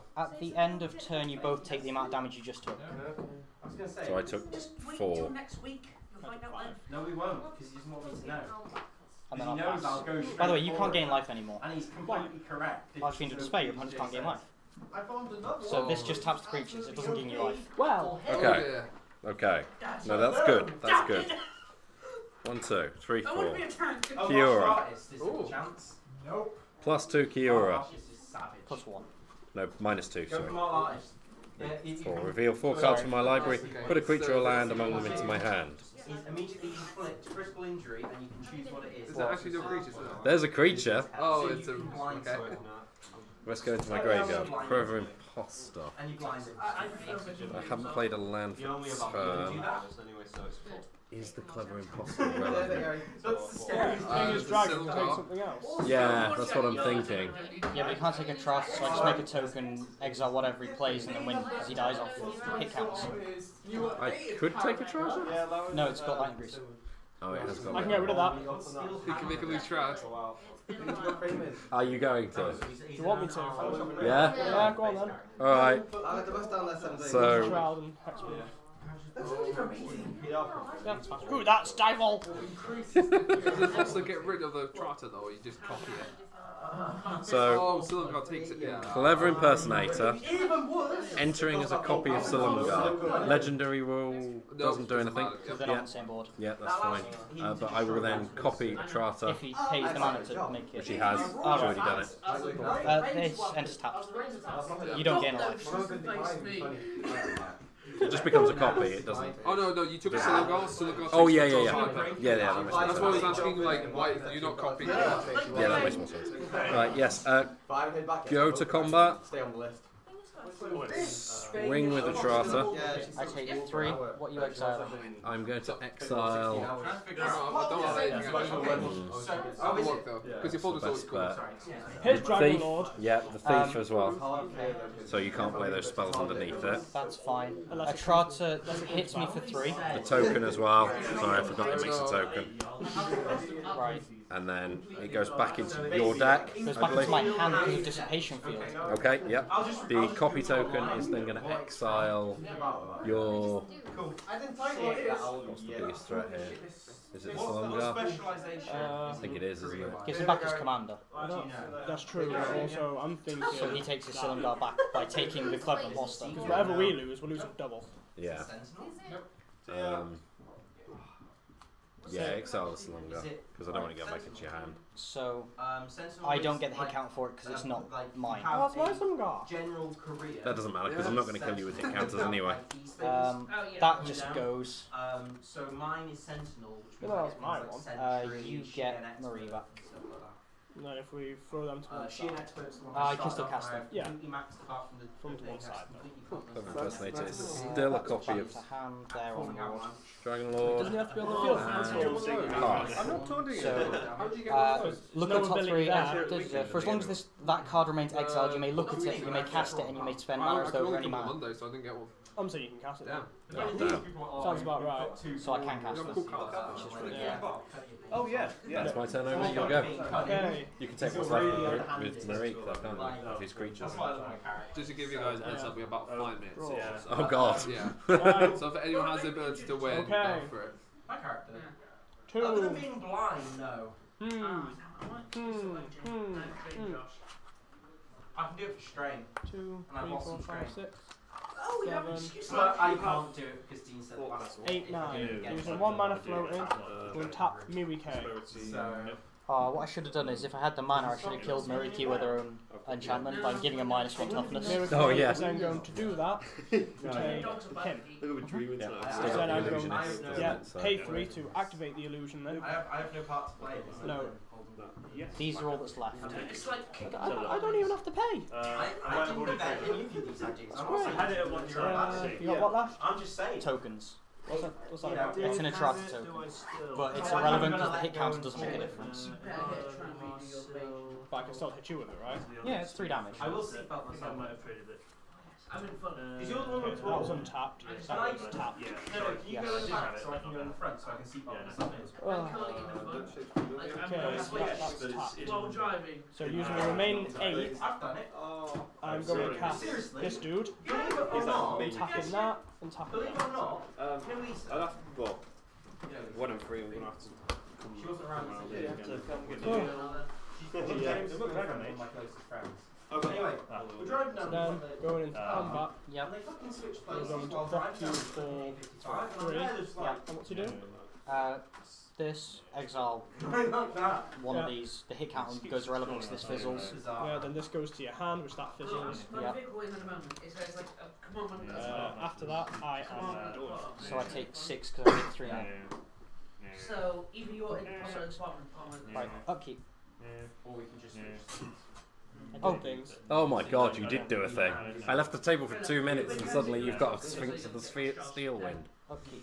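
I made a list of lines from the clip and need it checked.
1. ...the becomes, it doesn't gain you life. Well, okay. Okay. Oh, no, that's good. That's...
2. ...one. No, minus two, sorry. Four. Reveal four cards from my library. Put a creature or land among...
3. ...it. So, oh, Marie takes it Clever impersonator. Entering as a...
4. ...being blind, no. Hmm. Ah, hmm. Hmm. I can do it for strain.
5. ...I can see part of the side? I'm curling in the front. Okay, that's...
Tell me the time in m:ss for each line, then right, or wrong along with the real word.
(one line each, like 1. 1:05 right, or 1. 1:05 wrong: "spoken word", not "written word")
1. 0:16 wrong: "creatures", not "becomes"
2. 0:28 right
3. 1:25 wrong: "Silumgar", not "Marie"
4. 3:52 right
5. 4:51 right.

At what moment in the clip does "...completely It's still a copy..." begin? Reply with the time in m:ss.
3:16.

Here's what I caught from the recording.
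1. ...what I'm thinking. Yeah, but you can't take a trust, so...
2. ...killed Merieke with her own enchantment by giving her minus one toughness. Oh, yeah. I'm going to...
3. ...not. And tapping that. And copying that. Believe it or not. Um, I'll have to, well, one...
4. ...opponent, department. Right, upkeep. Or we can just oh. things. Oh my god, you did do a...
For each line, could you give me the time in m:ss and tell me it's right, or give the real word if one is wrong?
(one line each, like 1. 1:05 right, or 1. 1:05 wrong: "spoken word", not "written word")
1. 0:56 right
2. 4:11 right
3. 5:01 wrong: "tapping", not "copying"
4. 5:37 wrong: "department", not "opponent".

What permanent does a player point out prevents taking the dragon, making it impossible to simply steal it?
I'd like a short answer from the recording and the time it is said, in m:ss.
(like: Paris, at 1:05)
Lightning Greaves, at 1:06.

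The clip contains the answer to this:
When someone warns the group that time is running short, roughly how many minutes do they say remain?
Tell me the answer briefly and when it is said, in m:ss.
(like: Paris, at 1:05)
5, at 3:46.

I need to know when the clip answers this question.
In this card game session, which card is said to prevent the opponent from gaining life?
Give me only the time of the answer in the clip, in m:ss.
0:12.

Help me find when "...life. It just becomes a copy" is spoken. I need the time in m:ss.
1:45.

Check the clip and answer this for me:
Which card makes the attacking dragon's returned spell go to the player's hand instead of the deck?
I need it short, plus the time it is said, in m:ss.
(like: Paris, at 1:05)
Dissipation Field, at 2:27.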